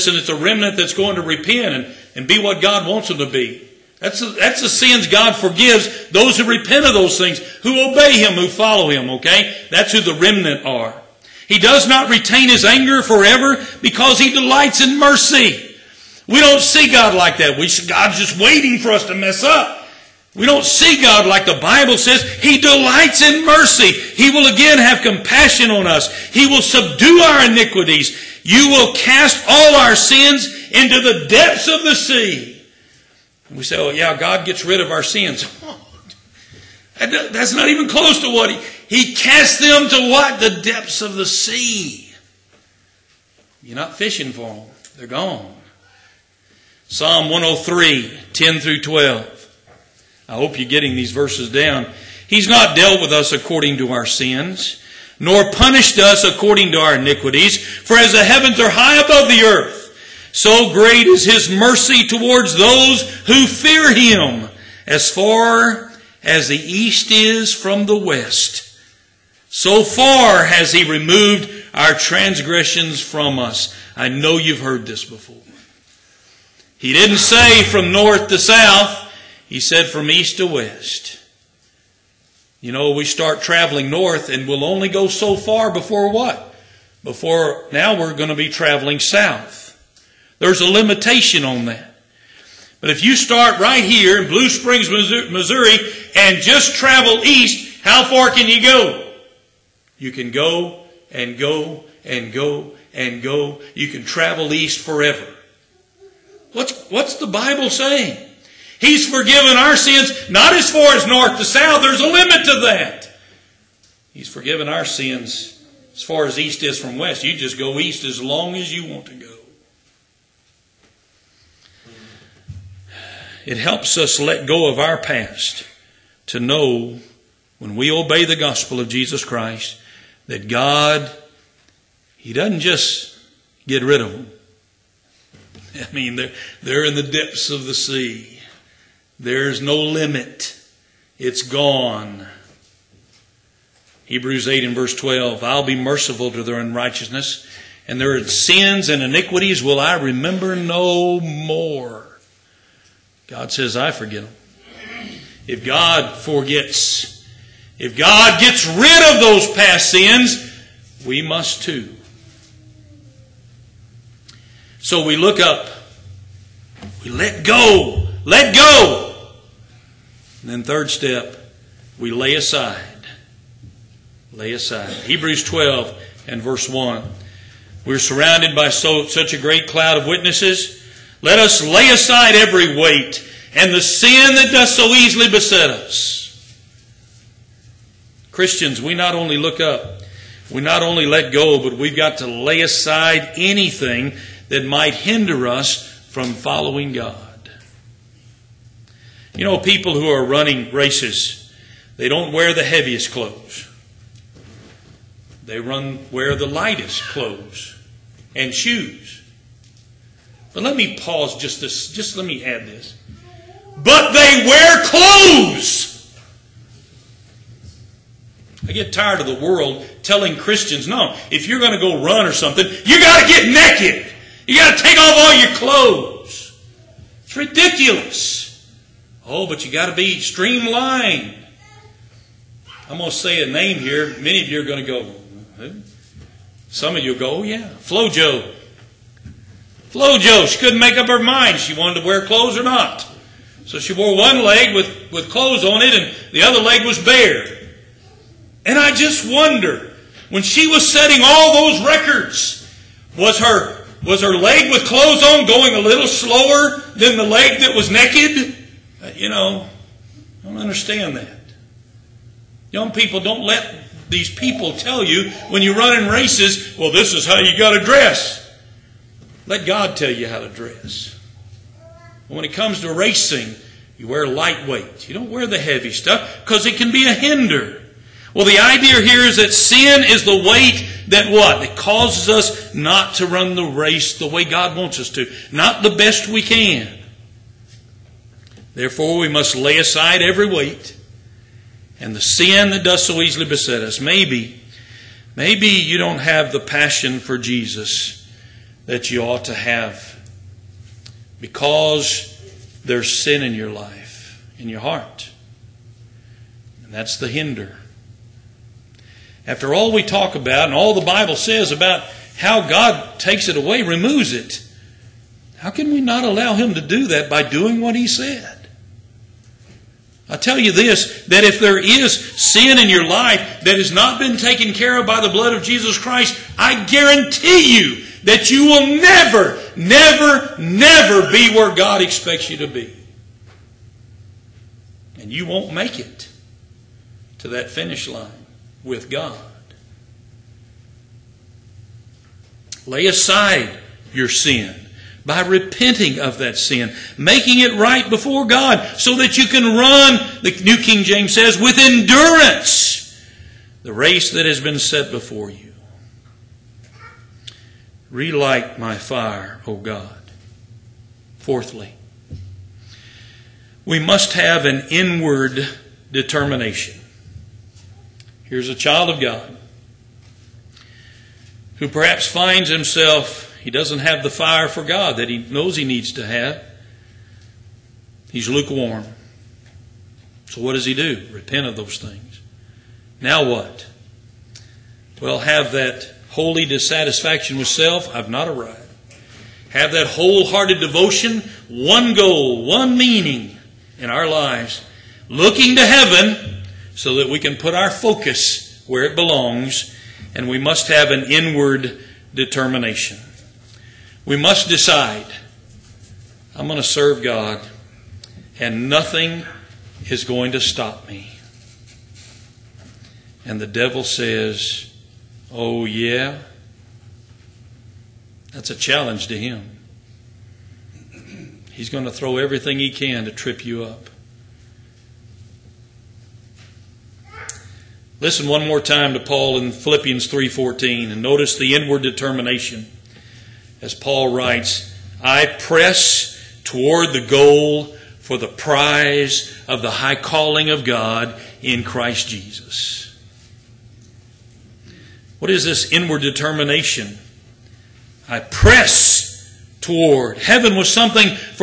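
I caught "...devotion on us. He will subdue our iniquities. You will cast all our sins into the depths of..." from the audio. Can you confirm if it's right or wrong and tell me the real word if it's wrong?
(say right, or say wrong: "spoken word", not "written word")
wrong: "compassion", not "devotion".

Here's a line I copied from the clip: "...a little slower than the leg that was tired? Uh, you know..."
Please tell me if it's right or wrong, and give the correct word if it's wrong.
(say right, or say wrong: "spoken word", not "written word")
wrong: "naked", not "tired".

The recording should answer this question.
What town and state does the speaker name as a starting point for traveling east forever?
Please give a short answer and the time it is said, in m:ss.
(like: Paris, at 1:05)
Blue Springs, Missouri, at 1:34.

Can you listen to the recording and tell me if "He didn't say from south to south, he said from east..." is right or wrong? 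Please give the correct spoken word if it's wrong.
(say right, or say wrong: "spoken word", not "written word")
wrong: "north", not "south".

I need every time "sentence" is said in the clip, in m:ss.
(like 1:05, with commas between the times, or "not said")
not said.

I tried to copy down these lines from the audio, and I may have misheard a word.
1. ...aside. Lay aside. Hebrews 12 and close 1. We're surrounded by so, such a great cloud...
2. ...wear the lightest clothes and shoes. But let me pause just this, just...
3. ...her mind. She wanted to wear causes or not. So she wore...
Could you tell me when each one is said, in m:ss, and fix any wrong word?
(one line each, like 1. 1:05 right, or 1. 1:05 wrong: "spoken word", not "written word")
1. 2:52 wrong: "verse", not "close"
2. 3:26 right
3. 4:01 wrong: "clothes", not "causes".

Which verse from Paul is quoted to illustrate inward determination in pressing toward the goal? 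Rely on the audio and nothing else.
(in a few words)
Philippians 3:14.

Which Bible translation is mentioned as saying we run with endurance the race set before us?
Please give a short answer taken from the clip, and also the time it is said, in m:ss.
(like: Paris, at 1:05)
New King James, at 5:50.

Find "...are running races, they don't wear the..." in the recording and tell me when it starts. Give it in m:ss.
3:20.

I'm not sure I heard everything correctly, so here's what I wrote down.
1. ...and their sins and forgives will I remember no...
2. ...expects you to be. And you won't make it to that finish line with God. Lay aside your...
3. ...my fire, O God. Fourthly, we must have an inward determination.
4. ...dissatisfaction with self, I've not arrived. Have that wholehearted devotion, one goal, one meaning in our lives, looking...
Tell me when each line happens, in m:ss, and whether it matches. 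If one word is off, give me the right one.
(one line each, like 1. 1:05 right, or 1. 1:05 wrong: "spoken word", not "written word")
1. 2:27 wrong: "iniquities", not "forgives"
2. 5:32 right
3. 5:58 right
4. 6:26 right.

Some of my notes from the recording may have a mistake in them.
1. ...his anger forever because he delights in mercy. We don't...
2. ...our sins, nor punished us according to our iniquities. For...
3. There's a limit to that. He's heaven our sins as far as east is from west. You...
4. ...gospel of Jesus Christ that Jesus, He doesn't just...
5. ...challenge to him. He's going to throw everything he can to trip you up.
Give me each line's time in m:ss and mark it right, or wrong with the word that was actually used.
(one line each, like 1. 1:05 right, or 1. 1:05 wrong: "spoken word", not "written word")
1. 0:12 right
2. 0:53 right
3. 1:51 wrong: "forgiven", not "heaven"
4. 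2:08 wrong: "God", not "Jesus"
5. 6:58 right.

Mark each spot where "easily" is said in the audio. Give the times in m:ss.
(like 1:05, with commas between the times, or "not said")
3:04, 4:53.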